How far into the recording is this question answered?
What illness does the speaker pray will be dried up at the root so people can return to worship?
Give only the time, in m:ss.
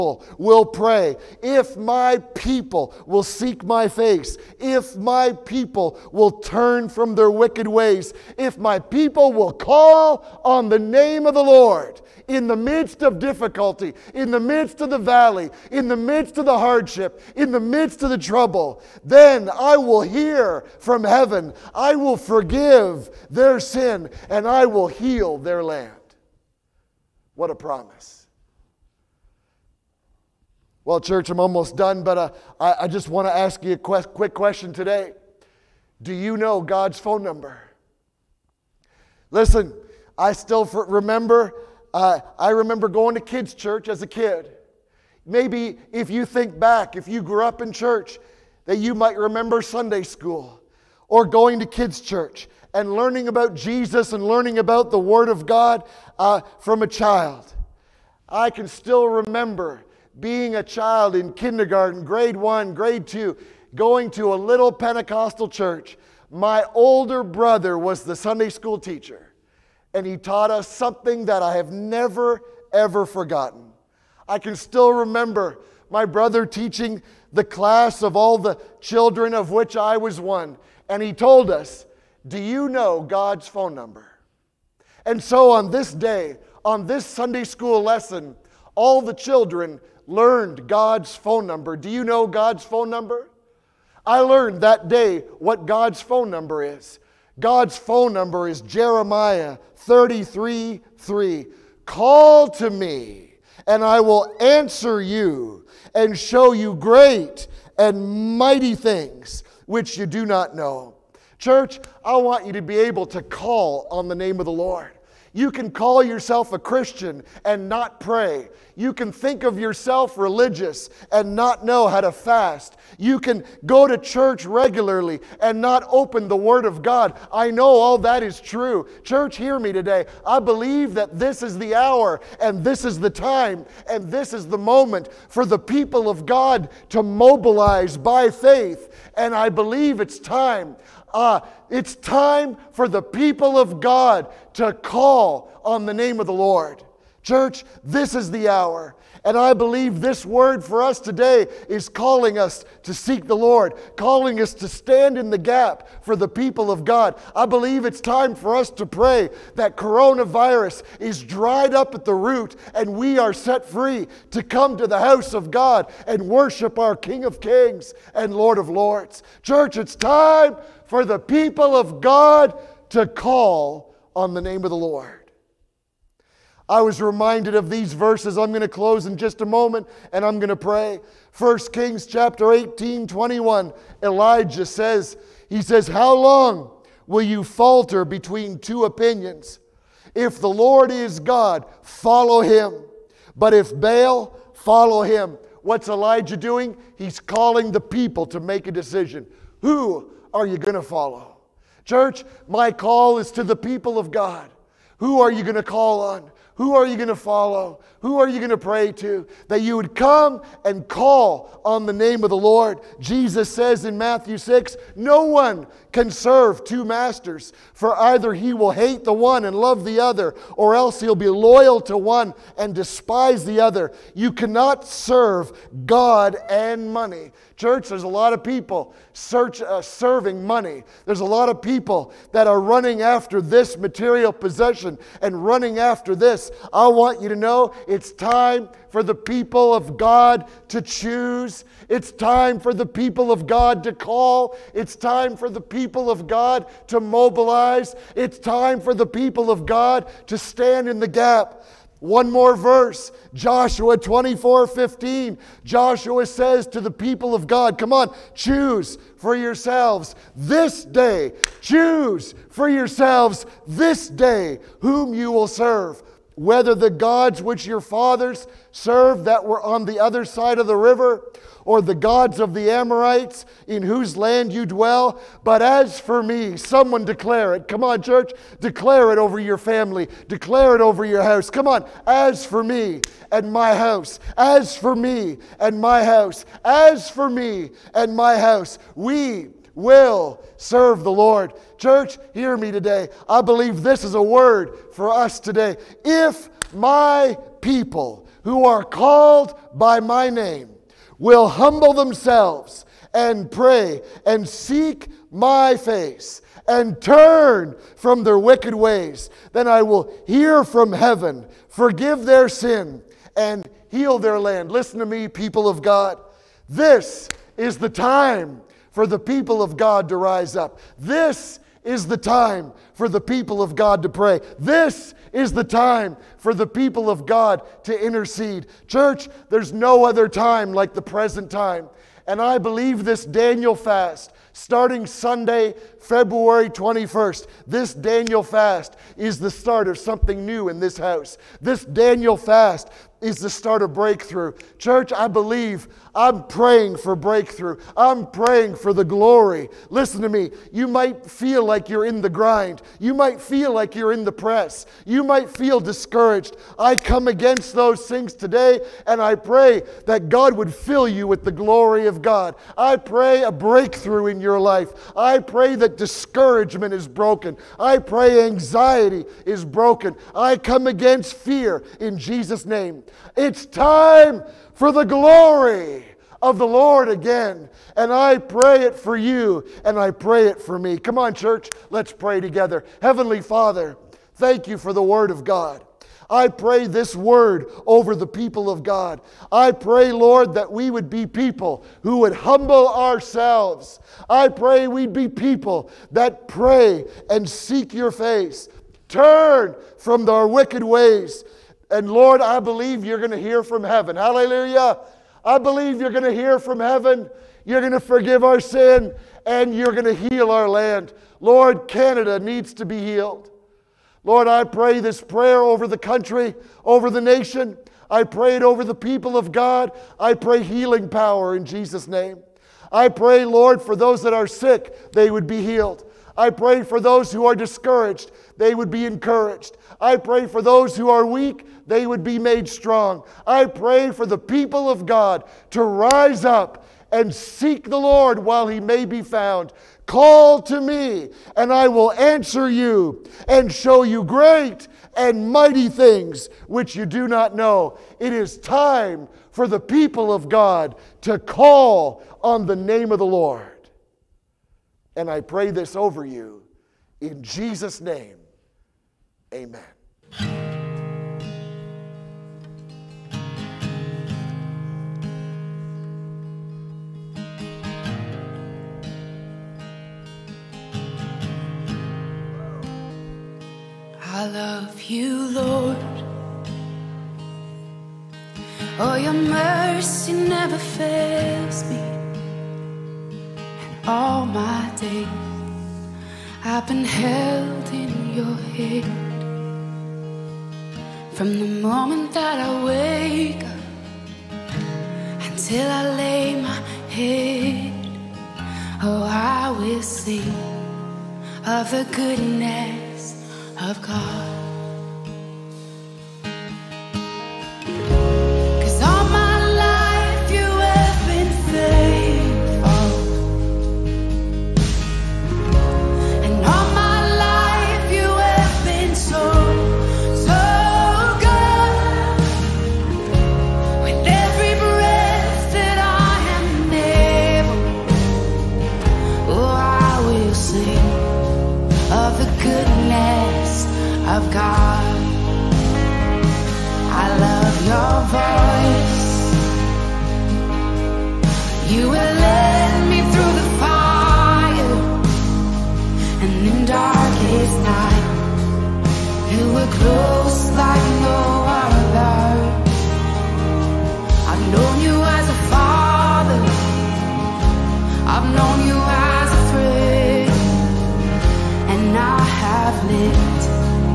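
2:39.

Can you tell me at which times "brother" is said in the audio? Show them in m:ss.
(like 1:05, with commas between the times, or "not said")
1:07, 1:16.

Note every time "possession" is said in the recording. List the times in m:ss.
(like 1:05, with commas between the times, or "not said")
3:54.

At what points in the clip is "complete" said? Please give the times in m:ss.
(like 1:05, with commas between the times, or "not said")
not said.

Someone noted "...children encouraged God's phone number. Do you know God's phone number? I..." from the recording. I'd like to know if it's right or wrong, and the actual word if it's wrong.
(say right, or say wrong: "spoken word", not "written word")
wrong: "learned", not "encouraged".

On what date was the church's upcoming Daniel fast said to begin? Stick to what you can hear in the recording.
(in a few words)
February 21st.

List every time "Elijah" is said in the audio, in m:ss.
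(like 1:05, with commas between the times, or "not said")
3:04, 3:15.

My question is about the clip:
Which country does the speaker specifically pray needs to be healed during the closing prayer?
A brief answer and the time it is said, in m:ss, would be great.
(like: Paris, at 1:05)
Canada, at 6:51.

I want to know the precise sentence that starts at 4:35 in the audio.
But as for me, someone declare it.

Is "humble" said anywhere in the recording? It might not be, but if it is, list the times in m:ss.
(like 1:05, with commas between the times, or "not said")
5:01, 6:32.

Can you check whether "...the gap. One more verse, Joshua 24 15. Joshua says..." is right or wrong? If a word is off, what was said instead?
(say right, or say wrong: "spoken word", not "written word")
right.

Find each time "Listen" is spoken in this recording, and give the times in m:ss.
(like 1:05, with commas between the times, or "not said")
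0:39, 5:14, 5:49.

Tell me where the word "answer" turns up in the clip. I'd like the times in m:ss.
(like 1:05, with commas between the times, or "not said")
1:44, 7:22.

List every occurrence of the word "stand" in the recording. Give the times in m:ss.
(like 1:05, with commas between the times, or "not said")
2:34, 4:10.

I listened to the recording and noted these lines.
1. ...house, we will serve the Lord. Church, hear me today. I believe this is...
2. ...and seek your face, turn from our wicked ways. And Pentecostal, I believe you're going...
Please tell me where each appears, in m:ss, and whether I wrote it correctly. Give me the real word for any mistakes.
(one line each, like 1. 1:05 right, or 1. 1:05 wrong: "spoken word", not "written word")
1. 4:48 right
2. 6:37 wrong: "Lord", not "Pentecostal".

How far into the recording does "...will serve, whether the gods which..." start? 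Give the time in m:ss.
4:25.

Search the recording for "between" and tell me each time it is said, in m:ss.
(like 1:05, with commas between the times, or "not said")
3:08.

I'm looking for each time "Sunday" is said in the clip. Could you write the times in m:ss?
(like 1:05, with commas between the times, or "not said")
0:49, 1:08, 1:27, 5:35.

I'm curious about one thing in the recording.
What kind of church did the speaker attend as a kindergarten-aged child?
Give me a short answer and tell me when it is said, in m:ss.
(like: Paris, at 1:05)
Pentecostal, at 1:04.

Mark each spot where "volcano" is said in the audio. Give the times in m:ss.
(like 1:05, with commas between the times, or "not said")
not said.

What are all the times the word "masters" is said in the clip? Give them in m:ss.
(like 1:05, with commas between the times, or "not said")
3:36.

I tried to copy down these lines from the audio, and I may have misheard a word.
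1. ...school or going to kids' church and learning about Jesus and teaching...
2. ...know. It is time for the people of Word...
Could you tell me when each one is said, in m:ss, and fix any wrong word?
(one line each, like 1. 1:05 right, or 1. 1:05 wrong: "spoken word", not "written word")
1. 0:50 wrong: "learning", not "teaching"
2. 7:27 wrong: "God", not "Word".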